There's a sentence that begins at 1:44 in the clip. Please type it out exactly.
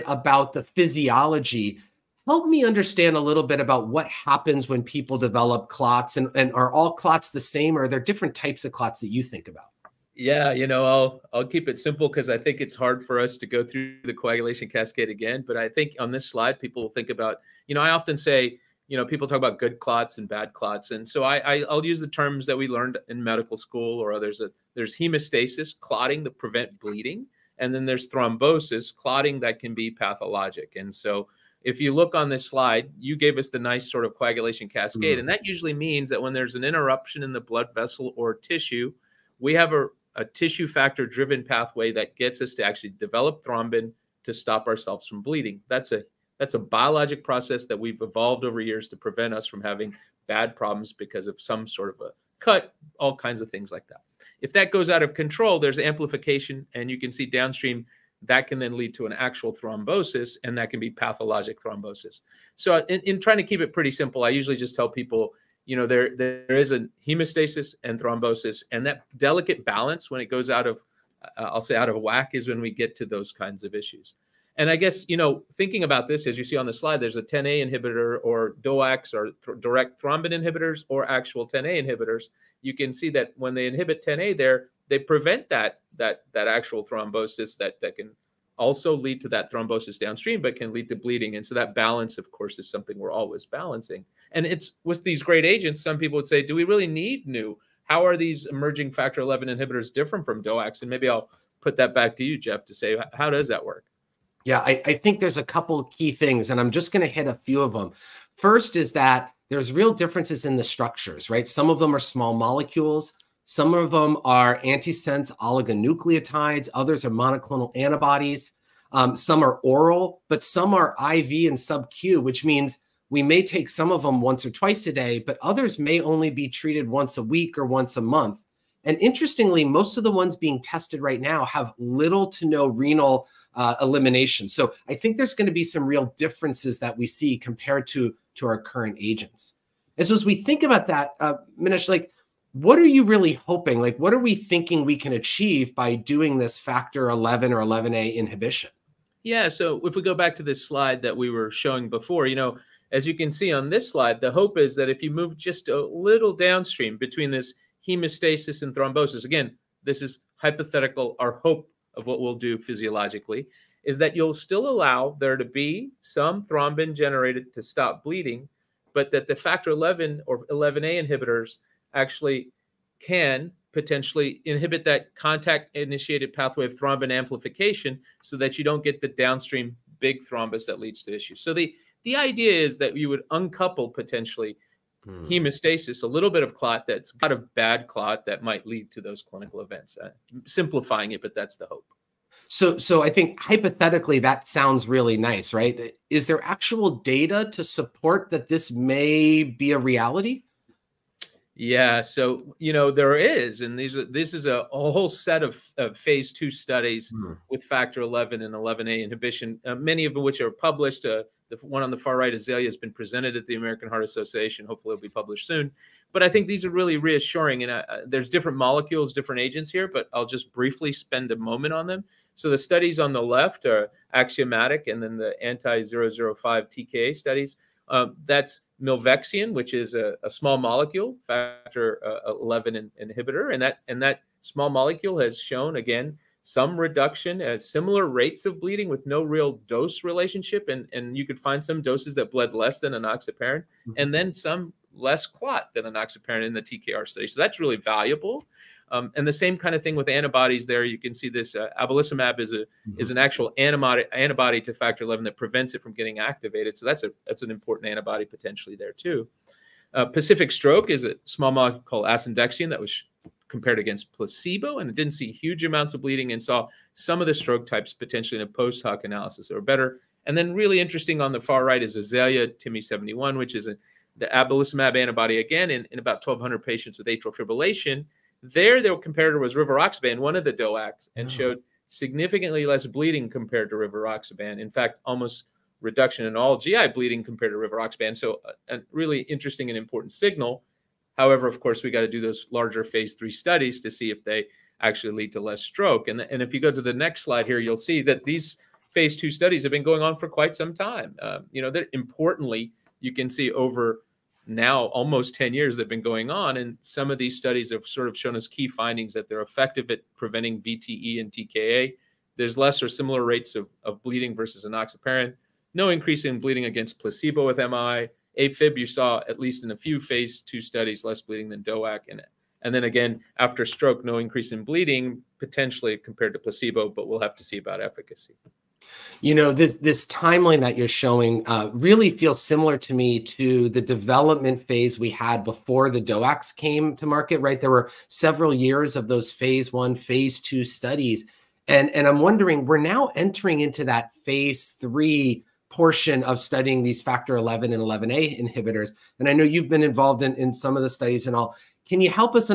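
Yeah, I, I think there's a couple key things, and I'm just going to hit a few of them.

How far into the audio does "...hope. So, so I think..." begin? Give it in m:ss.
3:11.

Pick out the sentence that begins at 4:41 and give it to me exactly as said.
showed significantly less bleeding compared to rivaroxaban.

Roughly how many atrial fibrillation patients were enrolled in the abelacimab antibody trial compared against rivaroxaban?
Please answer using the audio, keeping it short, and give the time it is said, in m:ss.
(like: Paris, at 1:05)
1,200, at 4:36.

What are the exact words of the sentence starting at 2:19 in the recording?
And so as we think about that, uh, Manesh, like, what are you really hoping?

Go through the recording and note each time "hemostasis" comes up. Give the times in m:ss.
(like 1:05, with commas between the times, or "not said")
0:24, 1:07, 2:37, 3:05.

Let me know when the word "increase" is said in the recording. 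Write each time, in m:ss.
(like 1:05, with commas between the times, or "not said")
5:15, 5:24.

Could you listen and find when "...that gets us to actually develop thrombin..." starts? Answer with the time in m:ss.
0:41.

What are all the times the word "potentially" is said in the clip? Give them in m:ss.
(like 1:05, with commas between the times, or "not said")
2:53, 3:03, 4:18, 4:27, 5:25.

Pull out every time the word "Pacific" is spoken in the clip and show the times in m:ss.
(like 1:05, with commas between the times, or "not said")
4:20.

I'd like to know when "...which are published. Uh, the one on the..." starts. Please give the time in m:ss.
3:30.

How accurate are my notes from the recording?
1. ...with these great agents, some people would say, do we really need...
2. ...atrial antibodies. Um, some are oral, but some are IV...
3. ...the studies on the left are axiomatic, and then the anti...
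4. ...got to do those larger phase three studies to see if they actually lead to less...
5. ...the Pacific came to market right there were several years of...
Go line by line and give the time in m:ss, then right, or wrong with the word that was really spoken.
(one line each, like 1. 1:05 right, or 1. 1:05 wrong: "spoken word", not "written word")
1. 1:34 right
2. 1:57 wrong: "monoclonal", not "atrial"
3. 3:42 right
4. 4:51 right
5. 5:35 wrong: "DOACs", not "Pacific".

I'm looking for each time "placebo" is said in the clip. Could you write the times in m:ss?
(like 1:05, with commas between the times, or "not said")
4:24, 5:16, 5:26.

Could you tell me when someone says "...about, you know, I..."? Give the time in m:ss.
0:17.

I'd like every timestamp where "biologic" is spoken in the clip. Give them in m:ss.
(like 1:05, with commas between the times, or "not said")
0:46.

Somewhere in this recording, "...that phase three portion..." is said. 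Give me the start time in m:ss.
5:43.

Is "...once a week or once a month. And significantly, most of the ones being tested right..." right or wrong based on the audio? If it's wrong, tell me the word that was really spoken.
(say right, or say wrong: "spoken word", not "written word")
wrong: "interestingly", not "significantly".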